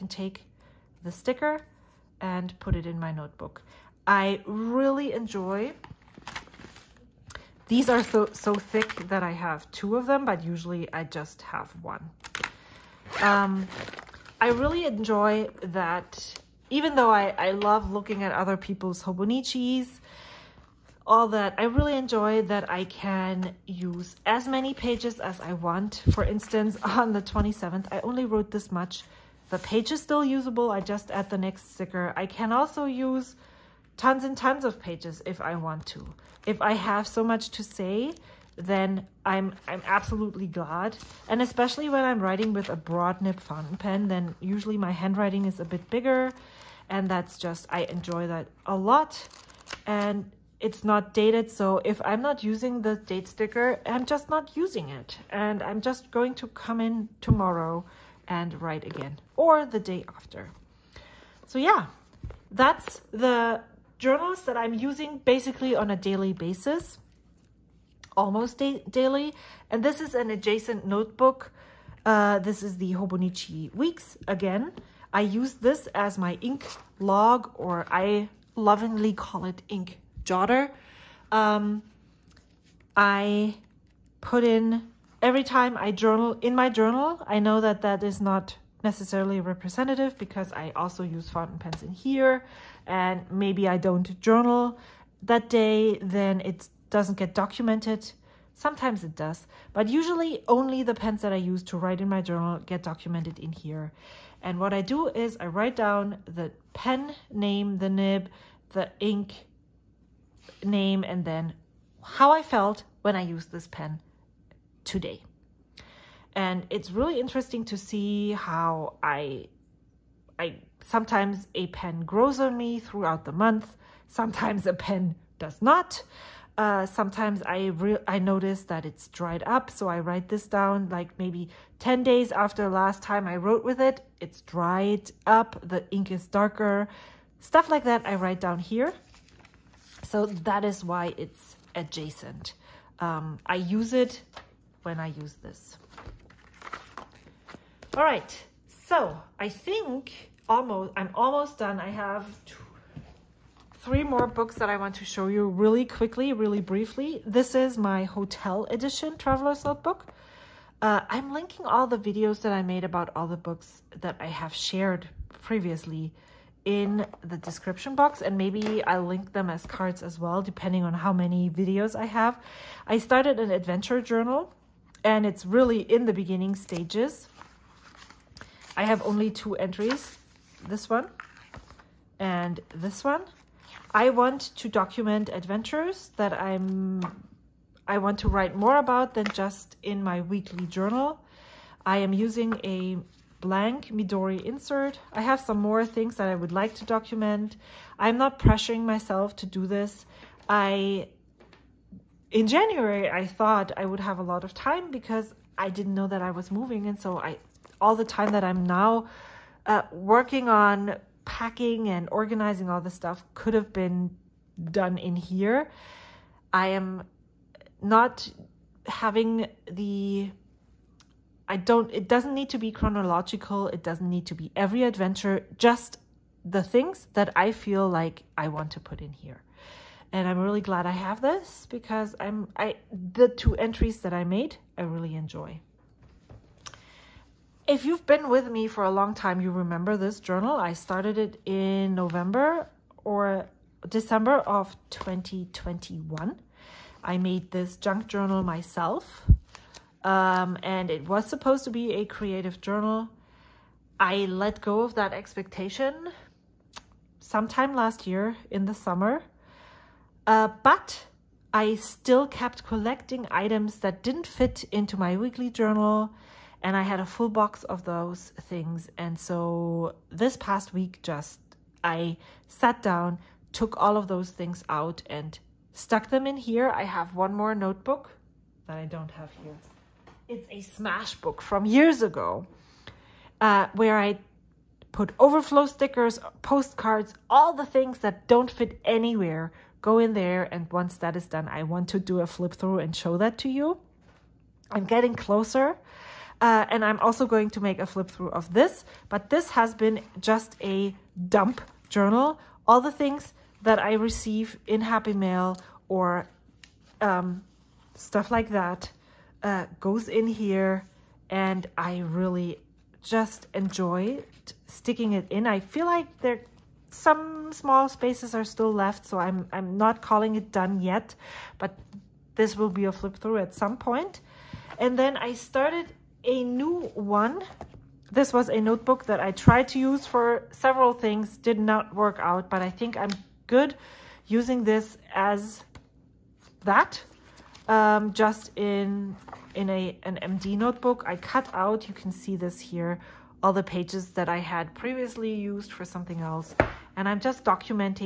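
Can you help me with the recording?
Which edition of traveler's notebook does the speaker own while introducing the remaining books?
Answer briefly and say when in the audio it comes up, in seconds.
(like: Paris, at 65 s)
hotel edition, at 158 s.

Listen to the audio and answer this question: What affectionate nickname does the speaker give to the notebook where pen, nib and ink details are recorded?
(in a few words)
ink jotter.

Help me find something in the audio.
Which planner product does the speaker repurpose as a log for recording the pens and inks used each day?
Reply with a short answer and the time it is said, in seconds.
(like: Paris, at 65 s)
Hobonichi Weeks, at 72 s.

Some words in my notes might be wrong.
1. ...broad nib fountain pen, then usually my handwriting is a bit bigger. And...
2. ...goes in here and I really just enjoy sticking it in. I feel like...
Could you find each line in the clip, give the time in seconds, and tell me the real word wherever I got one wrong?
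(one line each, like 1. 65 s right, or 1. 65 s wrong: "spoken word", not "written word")
1. 42 s right
2. 309 s right.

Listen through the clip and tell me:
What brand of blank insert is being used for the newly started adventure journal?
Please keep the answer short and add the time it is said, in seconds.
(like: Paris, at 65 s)
Midori, at 193 s.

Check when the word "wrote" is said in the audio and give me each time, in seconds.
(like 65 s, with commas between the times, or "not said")
28 s, 133 s.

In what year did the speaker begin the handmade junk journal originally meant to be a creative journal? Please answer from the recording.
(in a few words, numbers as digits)
2021.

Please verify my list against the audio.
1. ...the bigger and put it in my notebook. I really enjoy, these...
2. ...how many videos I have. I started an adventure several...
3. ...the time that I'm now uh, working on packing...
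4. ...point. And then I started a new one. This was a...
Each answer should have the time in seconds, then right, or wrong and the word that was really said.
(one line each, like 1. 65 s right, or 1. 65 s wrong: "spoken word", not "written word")
1. 1 s wrong: "sticker", not "bigger"
2. 170 s wrong: "journal", not "several"
3. 207 s right
4. 323 s right.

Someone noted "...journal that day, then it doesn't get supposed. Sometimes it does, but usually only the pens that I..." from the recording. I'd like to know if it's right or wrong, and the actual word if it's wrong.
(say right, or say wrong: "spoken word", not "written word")
wrong: "documented", not "supposed".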